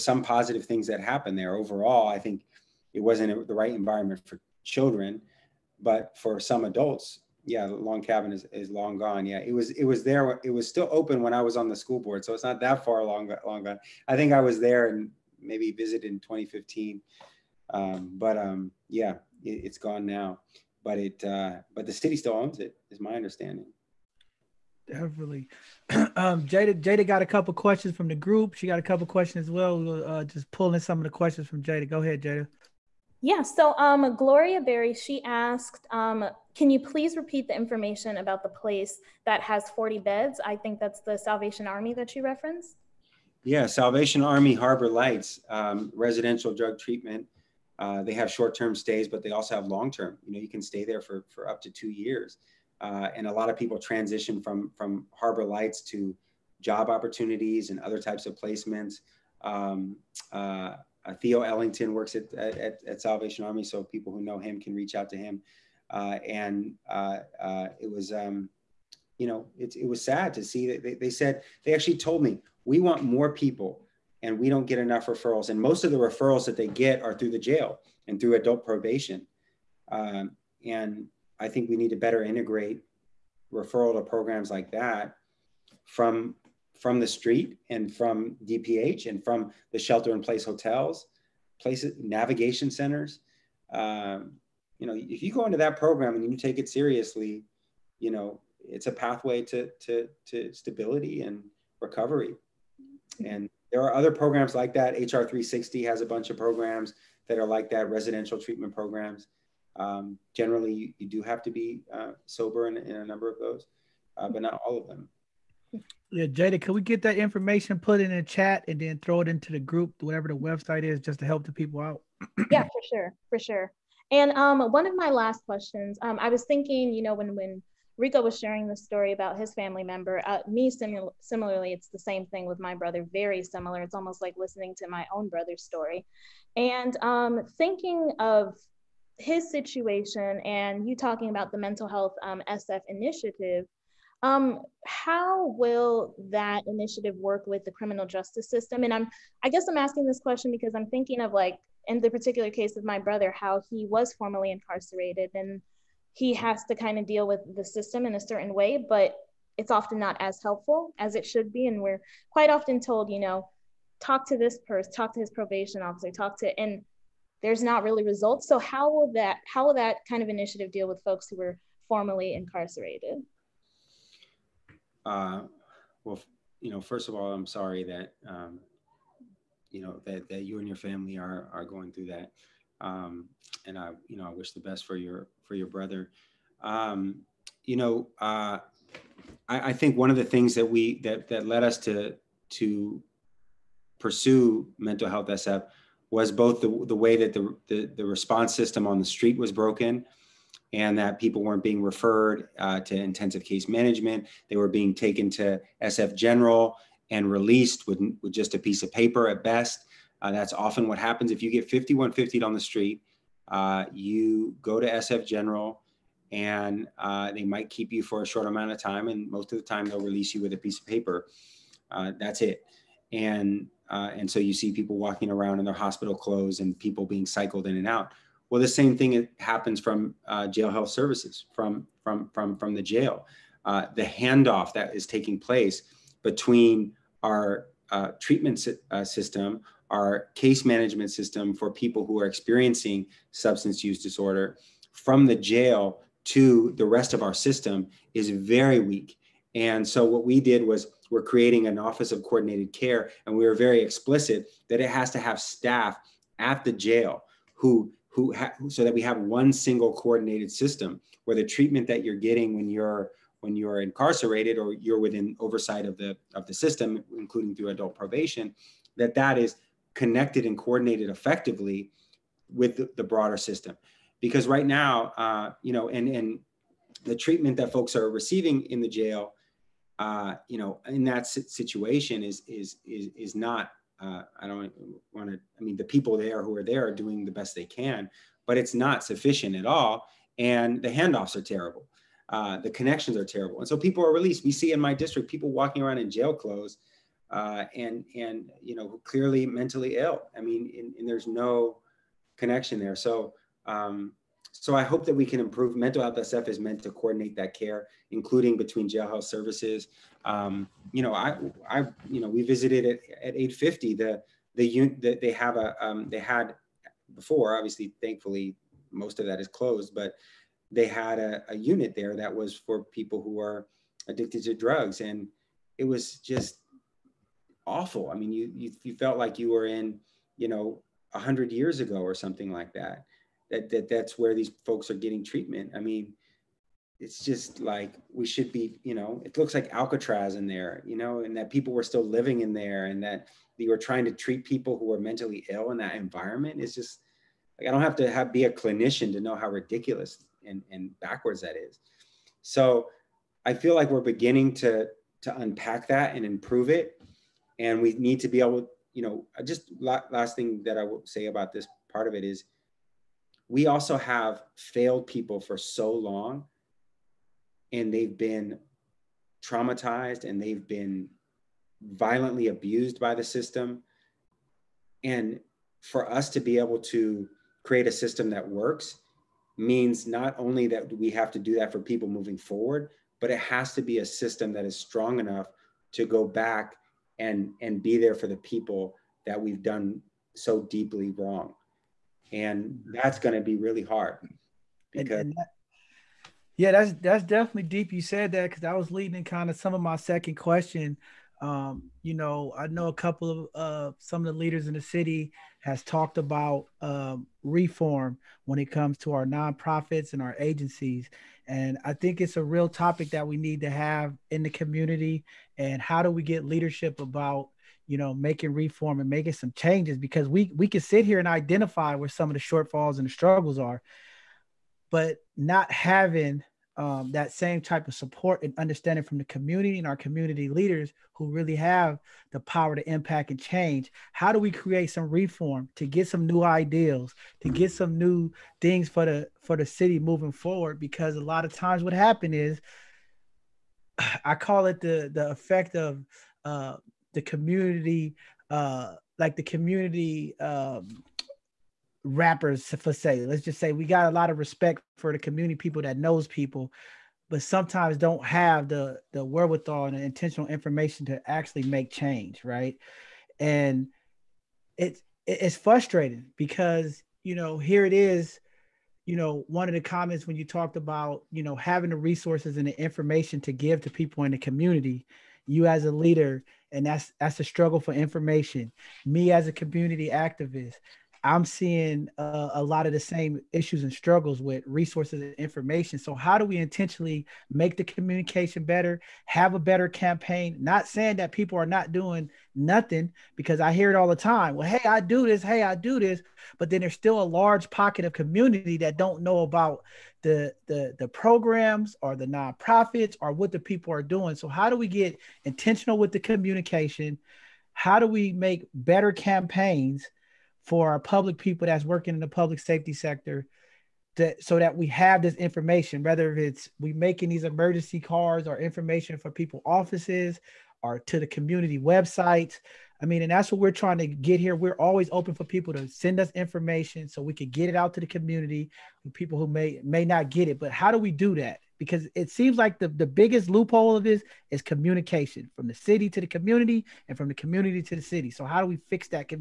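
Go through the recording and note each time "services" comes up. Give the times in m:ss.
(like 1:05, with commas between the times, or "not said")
3:50, 5:09.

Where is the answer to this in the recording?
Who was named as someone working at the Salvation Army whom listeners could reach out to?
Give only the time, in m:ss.
1:01.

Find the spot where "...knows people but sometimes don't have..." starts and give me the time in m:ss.
7:35.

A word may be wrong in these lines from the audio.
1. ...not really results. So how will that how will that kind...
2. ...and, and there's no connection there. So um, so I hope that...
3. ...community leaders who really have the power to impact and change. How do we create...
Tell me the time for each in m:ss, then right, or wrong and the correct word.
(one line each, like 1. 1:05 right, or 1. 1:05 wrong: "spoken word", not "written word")
1. 2:47 right
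2. 5:00 right
3. 7:09 right.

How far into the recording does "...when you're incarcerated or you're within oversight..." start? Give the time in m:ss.
4:23.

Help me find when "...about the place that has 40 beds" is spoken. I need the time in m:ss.
0:38.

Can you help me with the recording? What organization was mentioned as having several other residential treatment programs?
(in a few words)
HR 360.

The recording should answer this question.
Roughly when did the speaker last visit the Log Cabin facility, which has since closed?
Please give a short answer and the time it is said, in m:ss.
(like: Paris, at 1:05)
2015, at 0:16.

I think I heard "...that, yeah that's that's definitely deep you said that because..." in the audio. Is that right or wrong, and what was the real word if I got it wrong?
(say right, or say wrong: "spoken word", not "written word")
right.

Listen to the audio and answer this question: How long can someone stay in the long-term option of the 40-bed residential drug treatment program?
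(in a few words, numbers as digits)
2 years.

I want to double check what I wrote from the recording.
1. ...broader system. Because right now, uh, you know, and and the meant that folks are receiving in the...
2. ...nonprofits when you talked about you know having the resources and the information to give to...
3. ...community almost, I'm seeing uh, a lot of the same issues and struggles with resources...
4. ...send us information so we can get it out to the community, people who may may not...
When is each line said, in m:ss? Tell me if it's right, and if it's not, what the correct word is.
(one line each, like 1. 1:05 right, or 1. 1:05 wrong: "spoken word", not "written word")
1. 4:33 wrong: "treatment", not "meant"
2. 7:49 wrong: "comments", not "nonprofits"
3. 7:59 wrong: "activist", not "almost"
4. 8:45 right.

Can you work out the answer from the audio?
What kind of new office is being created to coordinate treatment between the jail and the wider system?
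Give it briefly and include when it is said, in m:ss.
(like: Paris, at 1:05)
office of coordinated care, at 4:11.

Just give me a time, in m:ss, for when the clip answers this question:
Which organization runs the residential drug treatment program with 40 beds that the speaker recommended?
0:43.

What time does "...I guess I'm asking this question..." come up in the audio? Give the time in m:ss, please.
2:29.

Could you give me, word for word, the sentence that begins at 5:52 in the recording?
So I feel like we're beginning to to unpack that and improve it.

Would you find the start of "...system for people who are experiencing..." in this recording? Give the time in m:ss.
4:01.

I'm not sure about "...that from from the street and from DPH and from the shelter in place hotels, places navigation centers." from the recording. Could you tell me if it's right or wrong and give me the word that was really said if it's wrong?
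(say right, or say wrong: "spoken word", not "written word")
right.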